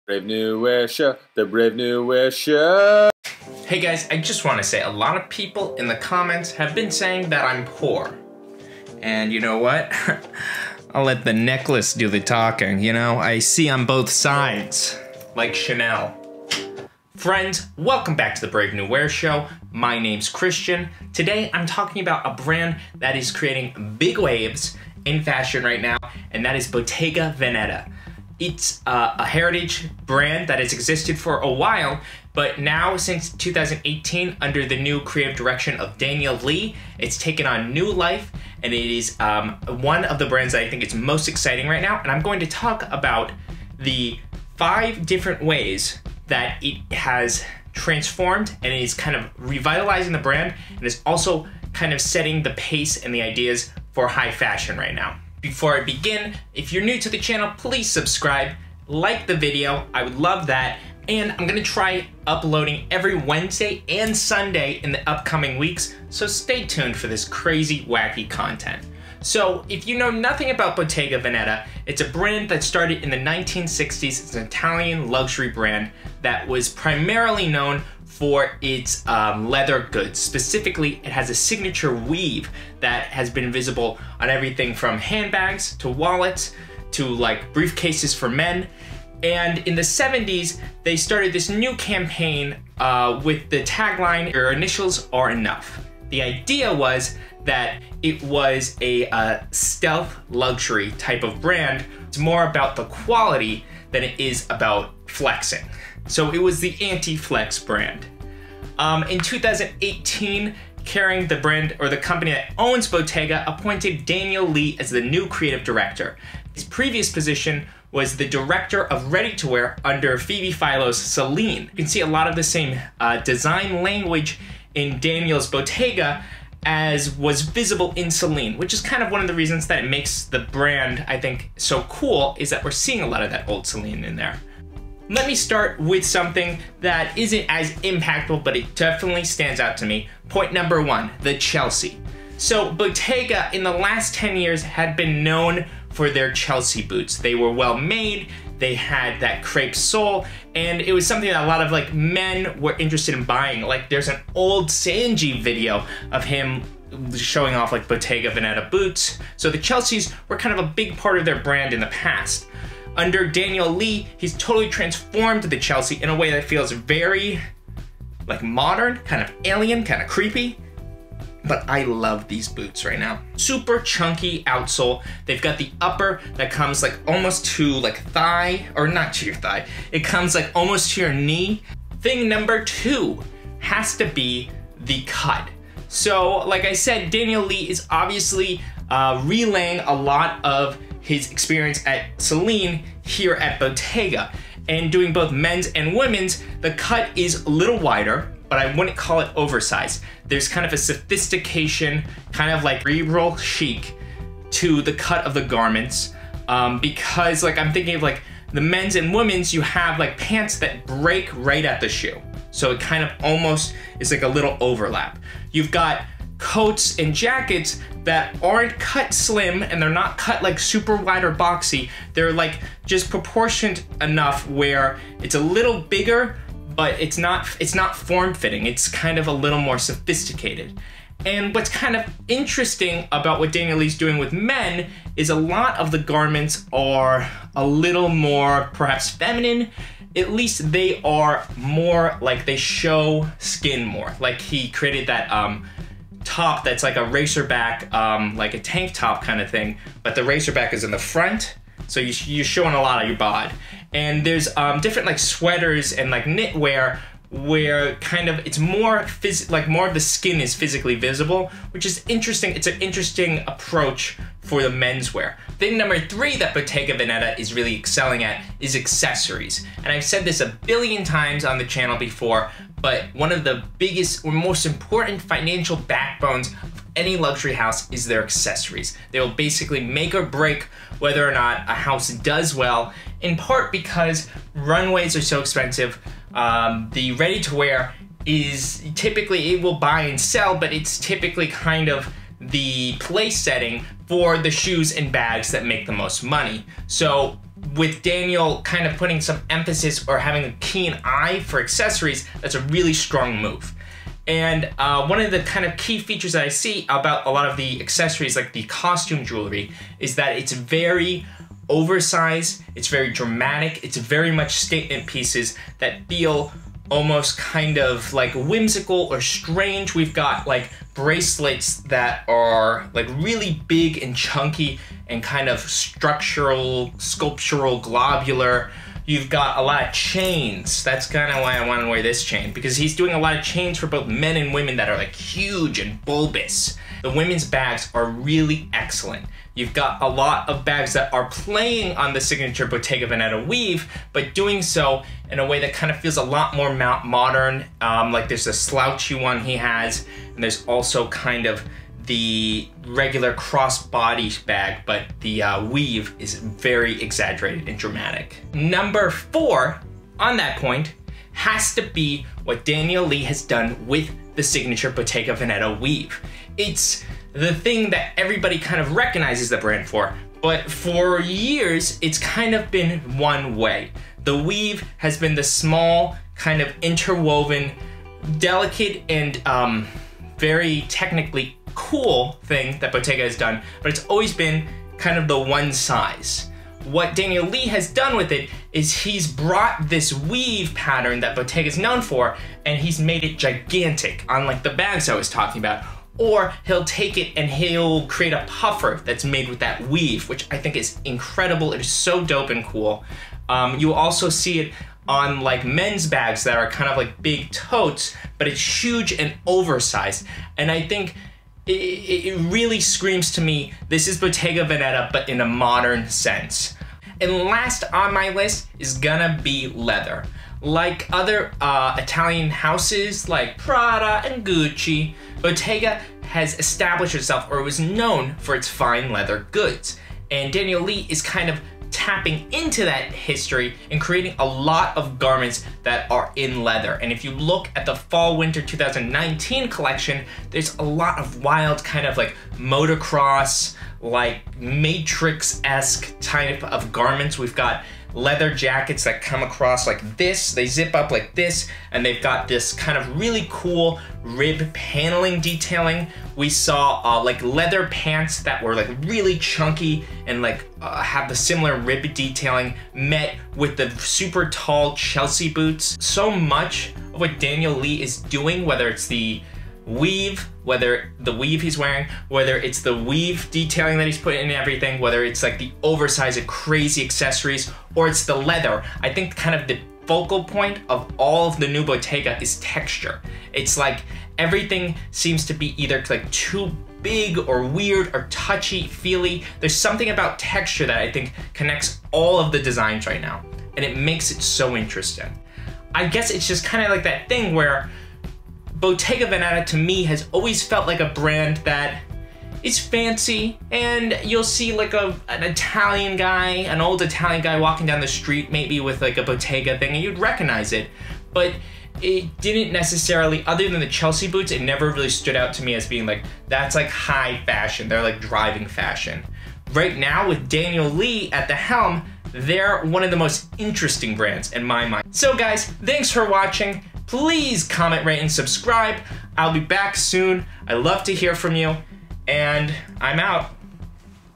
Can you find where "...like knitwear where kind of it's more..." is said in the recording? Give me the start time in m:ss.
4:16.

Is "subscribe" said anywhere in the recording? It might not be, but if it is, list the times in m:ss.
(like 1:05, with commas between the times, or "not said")
0:57, 8:48.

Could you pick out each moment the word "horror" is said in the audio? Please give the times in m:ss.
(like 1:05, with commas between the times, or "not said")
not said.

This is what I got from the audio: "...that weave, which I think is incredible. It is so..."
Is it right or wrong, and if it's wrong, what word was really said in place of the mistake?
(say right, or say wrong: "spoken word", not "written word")
right.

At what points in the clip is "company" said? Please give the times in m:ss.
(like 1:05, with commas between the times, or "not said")
1:51.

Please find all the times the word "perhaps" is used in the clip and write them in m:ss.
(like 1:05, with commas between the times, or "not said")
3:58.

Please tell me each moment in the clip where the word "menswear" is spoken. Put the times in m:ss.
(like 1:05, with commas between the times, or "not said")
4:24.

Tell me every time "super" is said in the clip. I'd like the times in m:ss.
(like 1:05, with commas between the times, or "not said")
2:53, 3:40, 7:43.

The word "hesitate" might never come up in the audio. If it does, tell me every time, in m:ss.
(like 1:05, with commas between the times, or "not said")
not said.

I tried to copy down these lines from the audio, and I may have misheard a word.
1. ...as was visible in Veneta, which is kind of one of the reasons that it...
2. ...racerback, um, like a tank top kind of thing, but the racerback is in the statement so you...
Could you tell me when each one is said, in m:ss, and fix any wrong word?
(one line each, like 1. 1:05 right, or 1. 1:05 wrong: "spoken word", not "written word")
1. 2:06 wrong: "Celine", not "Veneta"
2. 4:07 wrong: "front", not "statement".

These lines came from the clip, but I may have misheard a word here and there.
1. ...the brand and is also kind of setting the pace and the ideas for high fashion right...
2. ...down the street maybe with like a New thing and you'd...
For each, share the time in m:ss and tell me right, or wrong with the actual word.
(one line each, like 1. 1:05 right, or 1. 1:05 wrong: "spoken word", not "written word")
1. 0:50 right
2. 8:27 wrong: "Bottega", not "New".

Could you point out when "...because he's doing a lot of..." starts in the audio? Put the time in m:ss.
5:32.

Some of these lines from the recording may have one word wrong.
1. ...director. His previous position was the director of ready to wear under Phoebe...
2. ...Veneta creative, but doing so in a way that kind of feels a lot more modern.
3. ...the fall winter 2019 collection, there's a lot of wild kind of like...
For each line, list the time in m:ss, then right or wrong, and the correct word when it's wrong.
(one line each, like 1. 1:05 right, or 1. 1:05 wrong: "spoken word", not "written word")
1. 1:55 right
2. 5:43 wrong: "weave", not "creative"
3. 7:17 right.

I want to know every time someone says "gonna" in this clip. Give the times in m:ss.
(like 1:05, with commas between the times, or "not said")
1:01, 6:58.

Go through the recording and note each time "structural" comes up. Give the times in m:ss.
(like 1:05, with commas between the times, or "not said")
5:25.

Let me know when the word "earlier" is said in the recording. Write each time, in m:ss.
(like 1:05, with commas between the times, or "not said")
not said.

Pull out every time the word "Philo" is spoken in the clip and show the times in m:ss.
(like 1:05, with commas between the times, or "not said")
2:00.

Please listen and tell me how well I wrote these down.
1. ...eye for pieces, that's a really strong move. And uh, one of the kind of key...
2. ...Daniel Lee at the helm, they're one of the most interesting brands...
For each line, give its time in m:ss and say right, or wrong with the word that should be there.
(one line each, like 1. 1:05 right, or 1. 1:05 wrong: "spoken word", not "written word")
1. 5:01 wrong: "accessories", not "pieces"
2. 8:40 right.